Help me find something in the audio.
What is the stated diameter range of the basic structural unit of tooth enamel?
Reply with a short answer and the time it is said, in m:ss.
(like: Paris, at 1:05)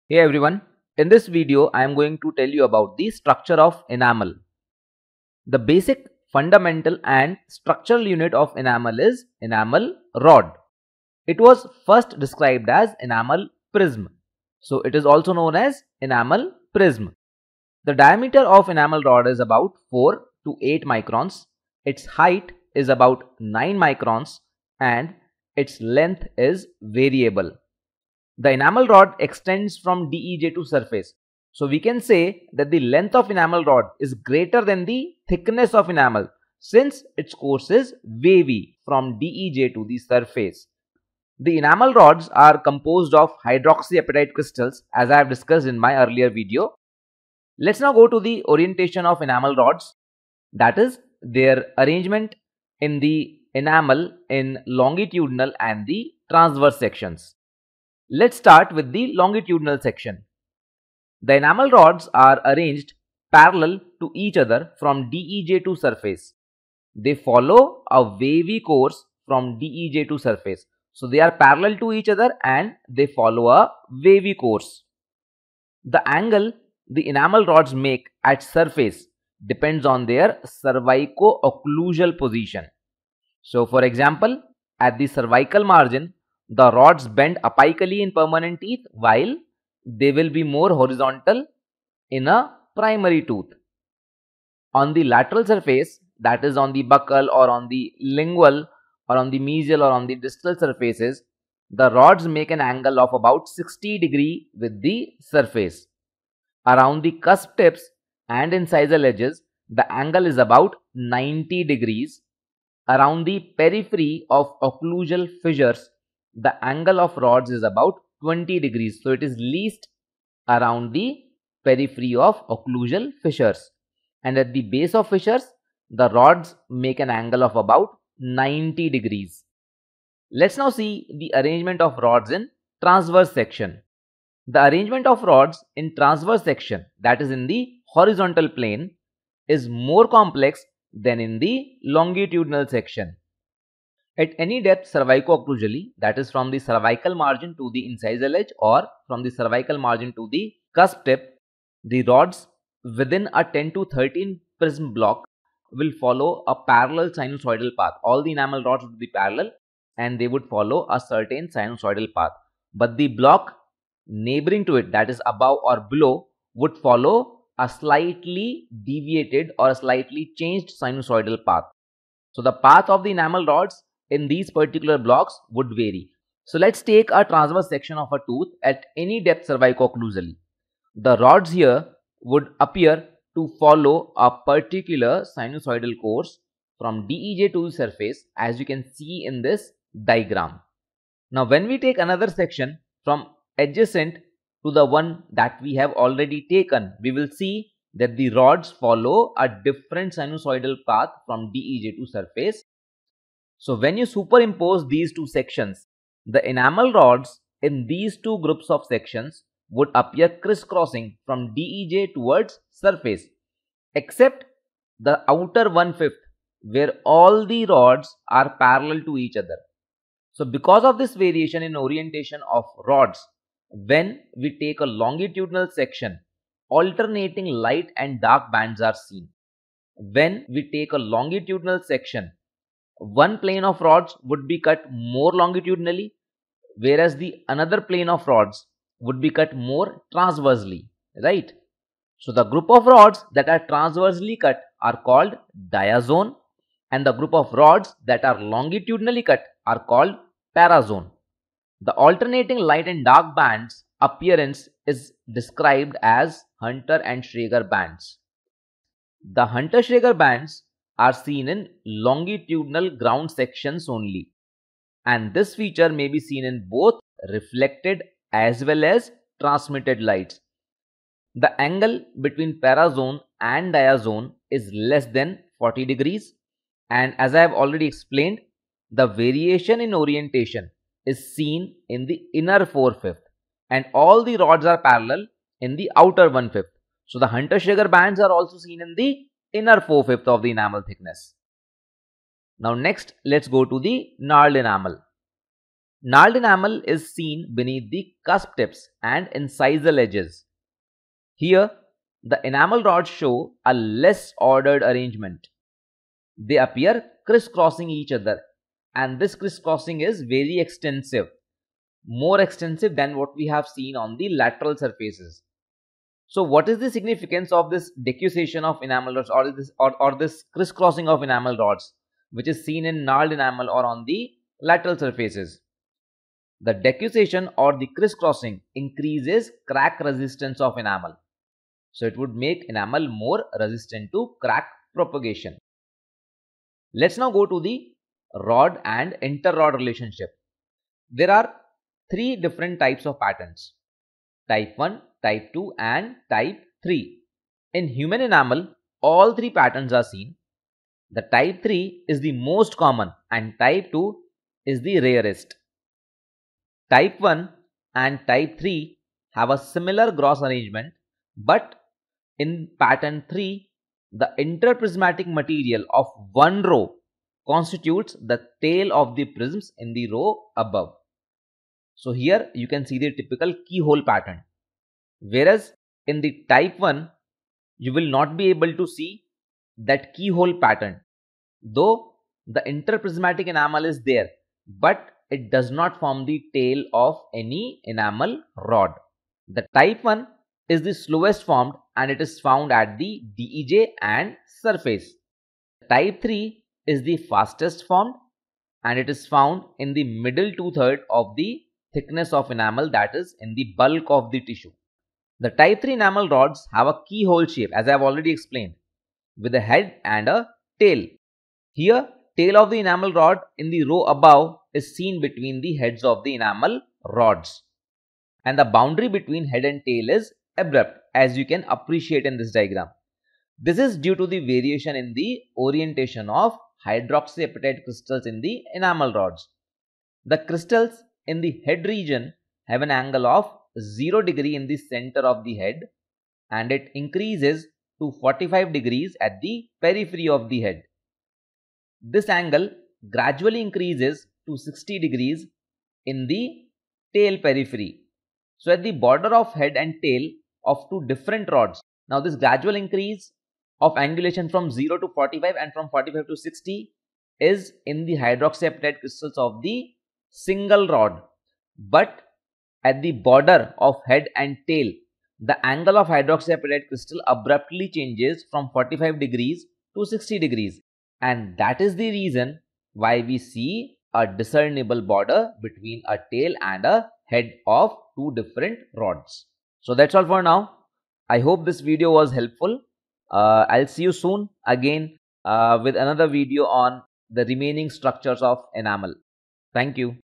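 4 to 8 microns, at 0:19.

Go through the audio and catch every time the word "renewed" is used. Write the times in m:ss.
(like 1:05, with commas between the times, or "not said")
not said.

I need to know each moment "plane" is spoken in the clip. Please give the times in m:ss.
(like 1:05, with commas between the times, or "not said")
2:18, 3:53, 3:57.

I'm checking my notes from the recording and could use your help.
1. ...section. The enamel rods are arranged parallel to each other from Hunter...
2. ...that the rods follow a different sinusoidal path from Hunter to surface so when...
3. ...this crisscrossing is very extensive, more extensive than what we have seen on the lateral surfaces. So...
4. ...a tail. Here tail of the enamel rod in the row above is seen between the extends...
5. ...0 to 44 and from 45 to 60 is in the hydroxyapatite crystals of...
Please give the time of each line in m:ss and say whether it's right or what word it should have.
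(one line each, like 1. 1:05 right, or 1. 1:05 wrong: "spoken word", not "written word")
1. 0:59 wrong: "DEJ", not "Hunter"
2. 3:17 wrong: "DEJ", not "Hunter"
3. 5:09 right
4. 6:50 wrong: "heads", not "extends"
5. 7:34 wrong: "45", not "44".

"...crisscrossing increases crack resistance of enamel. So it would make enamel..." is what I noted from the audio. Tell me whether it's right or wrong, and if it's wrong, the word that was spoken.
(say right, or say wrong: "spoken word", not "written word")
right.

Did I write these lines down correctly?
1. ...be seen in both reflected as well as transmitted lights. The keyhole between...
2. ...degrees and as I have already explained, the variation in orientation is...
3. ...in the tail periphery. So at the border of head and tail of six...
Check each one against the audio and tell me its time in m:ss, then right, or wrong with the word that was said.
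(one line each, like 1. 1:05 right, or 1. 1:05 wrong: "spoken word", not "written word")
1. 4:26 wrong: "angle", not "keyhole"
2. 4:35 right
3. 7:26 wrong: "two", not "six".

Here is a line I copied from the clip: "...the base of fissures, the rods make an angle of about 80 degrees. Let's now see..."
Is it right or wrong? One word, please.
wrong.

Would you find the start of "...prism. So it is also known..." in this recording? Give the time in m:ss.
0:13.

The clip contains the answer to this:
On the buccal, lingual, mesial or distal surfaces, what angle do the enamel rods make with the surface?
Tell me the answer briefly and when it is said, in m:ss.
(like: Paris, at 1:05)
60 degrees, at 1:43.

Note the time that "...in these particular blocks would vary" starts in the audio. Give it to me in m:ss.
2:54.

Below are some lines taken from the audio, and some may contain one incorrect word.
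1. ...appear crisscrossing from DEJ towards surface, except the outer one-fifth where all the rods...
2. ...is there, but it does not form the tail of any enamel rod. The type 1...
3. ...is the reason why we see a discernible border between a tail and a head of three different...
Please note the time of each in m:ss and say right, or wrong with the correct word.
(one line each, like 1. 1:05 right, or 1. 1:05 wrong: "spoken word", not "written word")
1. 3:29 right
2. 6:23 right
3. 7:51 wrong: "two", not "three".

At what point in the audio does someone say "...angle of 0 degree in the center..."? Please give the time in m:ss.
7:12.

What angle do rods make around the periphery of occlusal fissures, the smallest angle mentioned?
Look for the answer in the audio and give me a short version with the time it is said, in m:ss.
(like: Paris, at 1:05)
20 degrees, at 1:58.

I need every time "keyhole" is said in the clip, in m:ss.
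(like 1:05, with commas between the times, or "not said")
6:13, 6:20, 6:47.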